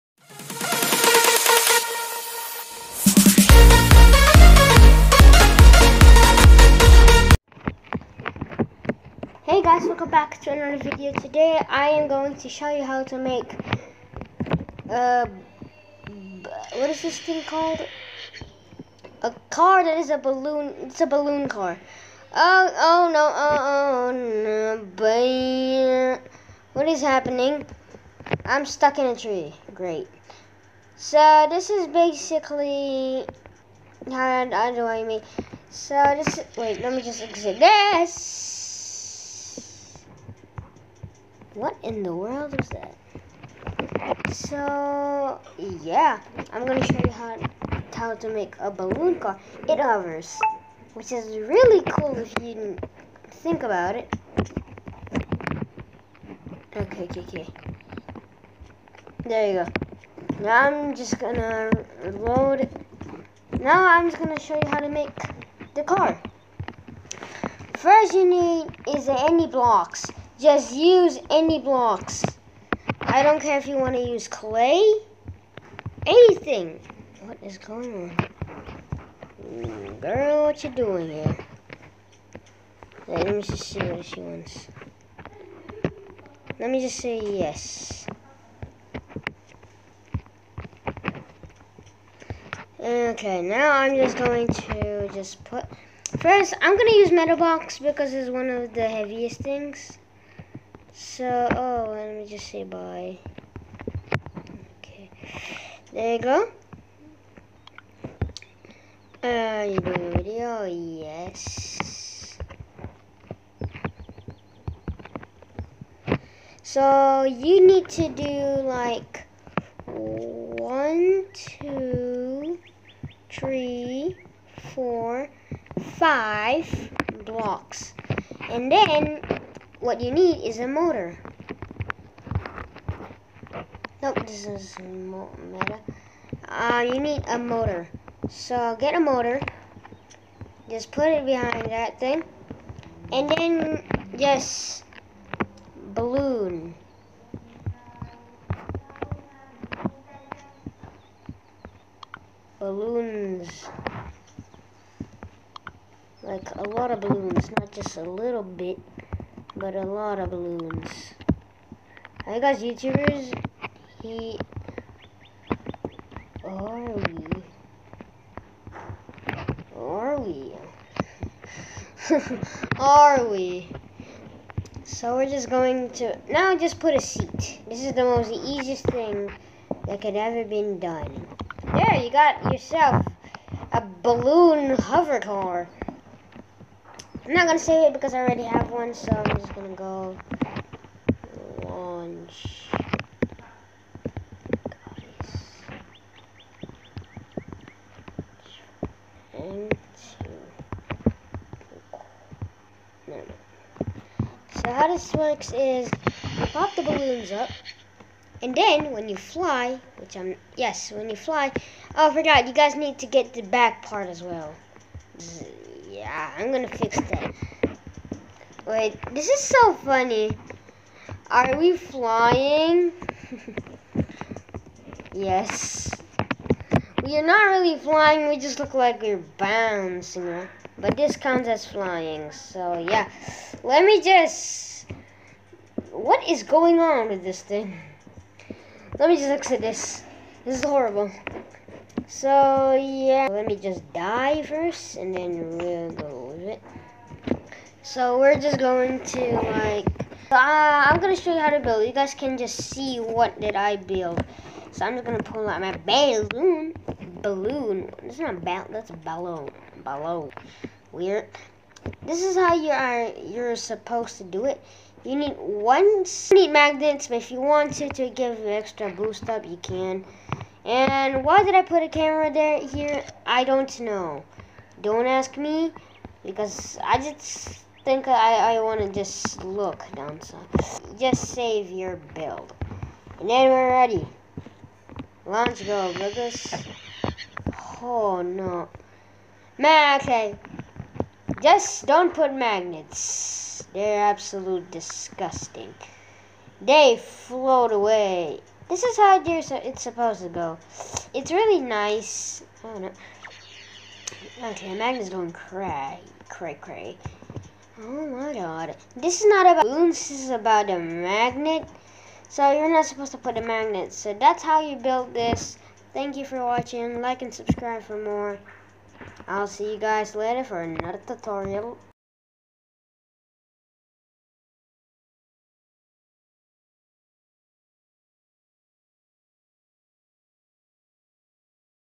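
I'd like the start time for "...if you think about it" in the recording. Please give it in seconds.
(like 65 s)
52 s.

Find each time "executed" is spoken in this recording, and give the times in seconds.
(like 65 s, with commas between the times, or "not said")
not said.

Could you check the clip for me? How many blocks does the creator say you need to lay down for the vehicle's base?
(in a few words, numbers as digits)
5.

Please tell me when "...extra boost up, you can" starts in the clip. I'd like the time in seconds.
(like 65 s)
268 s.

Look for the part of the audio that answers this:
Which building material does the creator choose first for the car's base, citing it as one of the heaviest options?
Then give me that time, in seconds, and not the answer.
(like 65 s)
97 s.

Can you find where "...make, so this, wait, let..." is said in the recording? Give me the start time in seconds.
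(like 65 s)
35 s.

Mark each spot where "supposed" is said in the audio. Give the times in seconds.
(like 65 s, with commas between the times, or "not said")
263 s, 299 s, 312 s.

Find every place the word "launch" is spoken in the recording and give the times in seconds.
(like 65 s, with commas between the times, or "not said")
191 s, 285 s.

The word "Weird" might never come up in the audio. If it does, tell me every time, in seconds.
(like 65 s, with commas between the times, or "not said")
260 s.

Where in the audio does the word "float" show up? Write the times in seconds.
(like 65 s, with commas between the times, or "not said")
297 s.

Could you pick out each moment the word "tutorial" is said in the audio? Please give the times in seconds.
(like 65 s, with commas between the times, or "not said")
321 s.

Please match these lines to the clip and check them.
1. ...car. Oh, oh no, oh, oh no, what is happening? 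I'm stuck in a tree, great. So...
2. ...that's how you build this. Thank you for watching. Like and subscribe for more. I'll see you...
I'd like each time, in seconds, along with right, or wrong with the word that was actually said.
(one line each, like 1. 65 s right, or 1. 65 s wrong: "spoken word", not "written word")
1. 21 s right
2. 314 s right.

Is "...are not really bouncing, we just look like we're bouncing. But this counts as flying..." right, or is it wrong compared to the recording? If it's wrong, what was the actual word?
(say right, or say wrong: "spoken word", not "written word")
wrong: "flying", not "bouncing".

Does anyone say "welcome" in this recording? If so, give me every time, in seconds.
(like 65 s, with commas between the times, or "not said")
9 s.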